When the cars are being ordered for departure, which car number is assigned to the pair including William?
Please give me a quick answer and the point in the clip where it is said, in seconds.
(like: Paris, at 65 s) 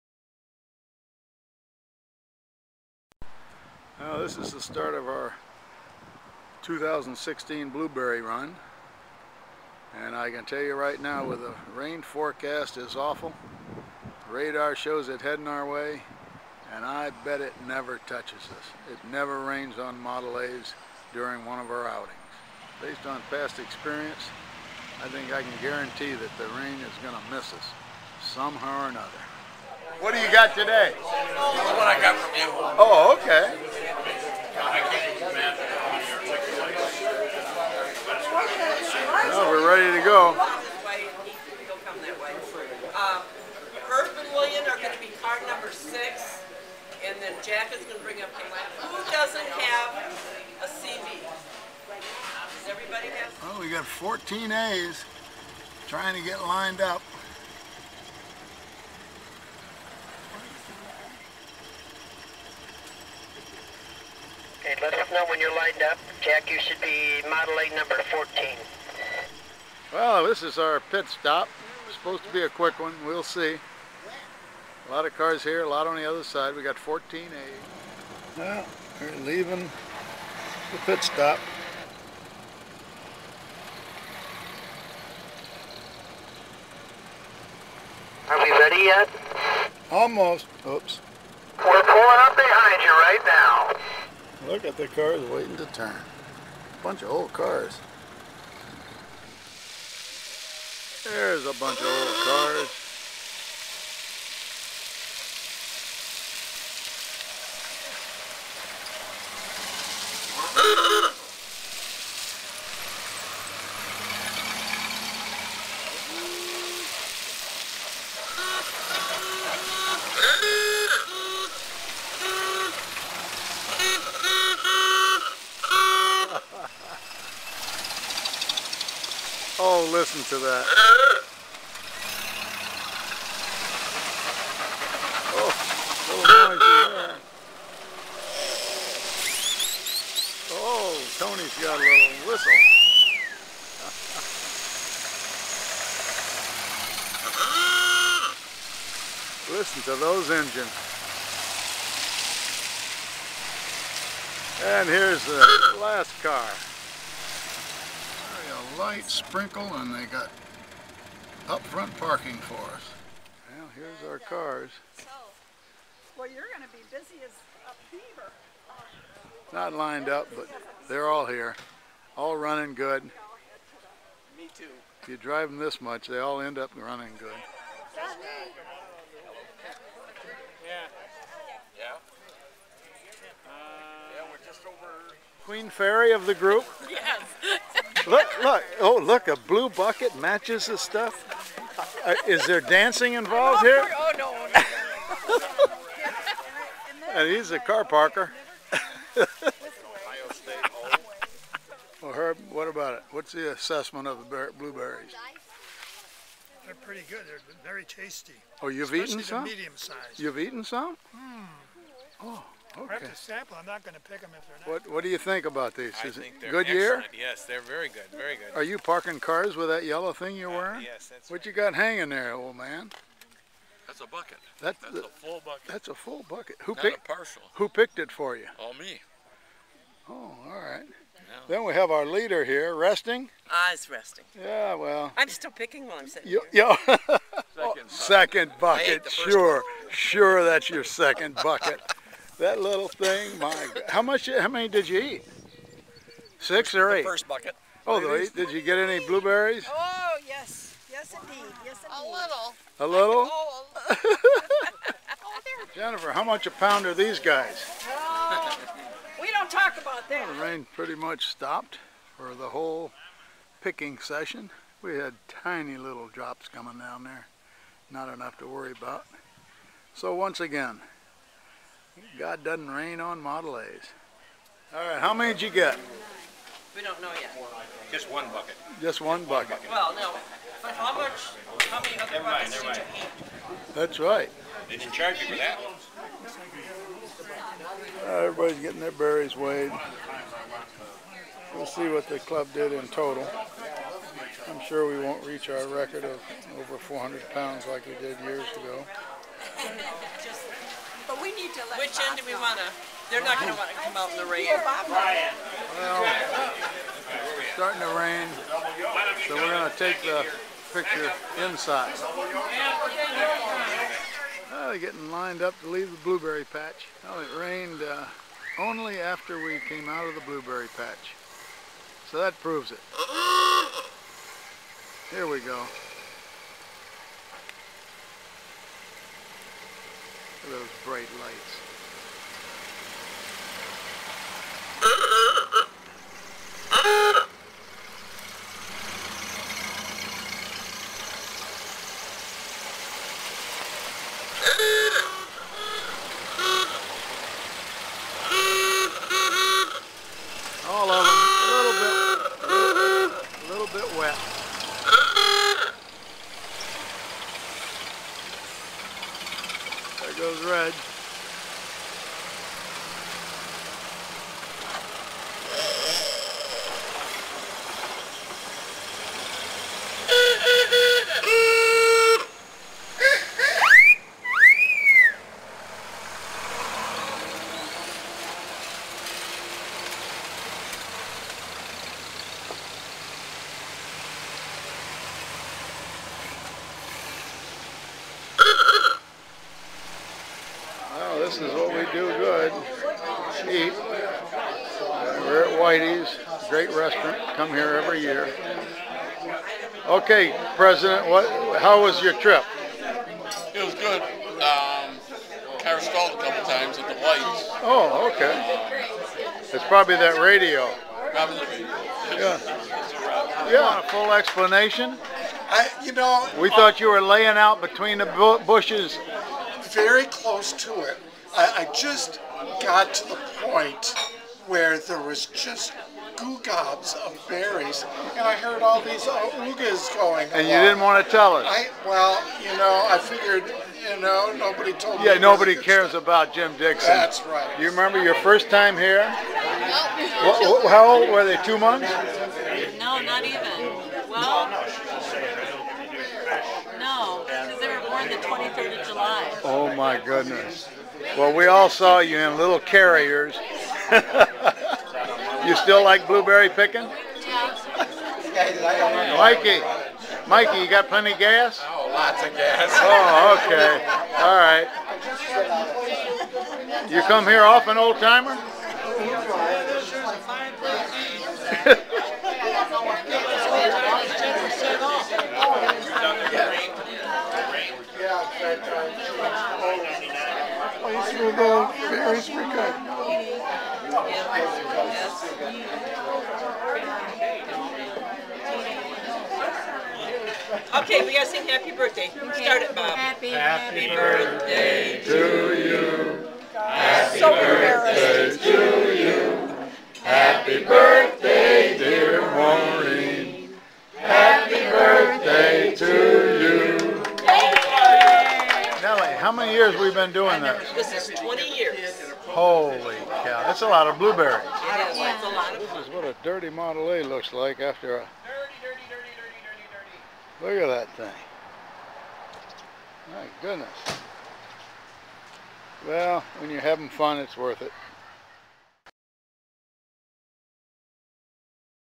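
6, at 45 s.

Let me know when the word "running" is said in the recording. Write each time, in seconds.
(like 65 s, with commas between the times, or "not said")
172 s, 176 s.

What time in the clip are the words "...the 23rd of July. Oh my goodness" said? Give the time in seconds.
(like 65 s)
448 s.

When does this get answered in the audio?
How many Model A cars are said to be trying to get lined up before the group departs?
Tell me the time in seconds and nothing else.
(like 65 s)
53 s.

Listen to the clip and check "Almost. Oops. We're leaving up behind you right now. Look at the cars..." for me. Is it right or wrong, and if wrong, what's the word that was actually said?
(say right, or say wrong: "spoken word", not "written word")
wrong: "pulling", not "leaving".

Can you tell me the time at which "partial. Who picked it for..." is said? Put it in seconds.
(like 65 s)
227 s.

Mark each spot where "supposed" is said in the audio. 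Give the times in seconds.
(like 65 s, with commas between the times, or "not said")
71 s.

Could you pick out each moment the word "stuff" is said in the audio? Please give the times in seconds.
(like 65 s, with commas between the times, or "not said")
190 s, 435 s.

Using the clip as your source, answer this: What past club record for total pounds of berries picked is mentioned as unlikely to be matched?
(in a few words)
Over 400 pounds.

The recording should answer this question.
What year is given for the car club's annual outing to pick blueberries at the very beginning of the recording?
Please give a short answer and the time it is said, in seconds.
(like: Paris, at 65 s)
2016, at 6 s.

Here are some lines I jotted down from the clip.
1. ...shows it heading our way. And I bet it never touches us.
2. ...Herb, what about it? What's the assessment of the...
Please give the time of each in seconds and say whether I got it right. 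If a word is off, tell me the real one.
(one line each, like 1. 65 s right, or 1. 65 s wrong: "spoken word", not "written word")
1. 14 s right
2. 202 s right.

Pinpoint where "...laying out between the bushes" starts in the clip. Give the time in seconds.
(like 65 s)
417 s.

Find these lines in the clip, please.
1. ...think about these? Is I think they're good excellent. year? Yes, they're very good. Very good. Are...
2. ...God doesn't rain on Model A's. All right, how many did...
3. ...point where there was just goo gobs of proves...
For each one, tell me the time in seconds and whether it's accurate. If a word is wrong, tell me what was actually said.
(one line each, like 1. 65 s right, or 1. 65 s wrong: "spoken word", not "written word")
1. 215 s right
2. 272 s right
3. 423 s wrong: "berries", not "proves".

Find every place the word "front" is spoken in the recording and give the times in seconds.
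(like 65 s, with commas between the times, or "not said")
161 s.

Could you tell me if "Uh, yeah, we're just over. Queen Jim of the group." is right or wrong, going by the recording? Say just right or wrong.
wrong.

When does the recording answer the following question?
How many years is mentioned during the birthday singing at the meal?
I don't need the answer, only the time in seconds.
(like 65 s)
511 s.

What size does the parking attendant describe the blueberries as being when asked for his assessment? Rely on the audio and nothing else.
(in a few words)
Medium.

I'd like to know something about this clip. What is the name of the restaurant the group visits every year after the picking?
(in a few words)
Whitey's.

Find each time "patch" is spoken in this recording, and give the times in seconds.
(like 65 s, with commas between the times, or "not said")
316 s, 320 s.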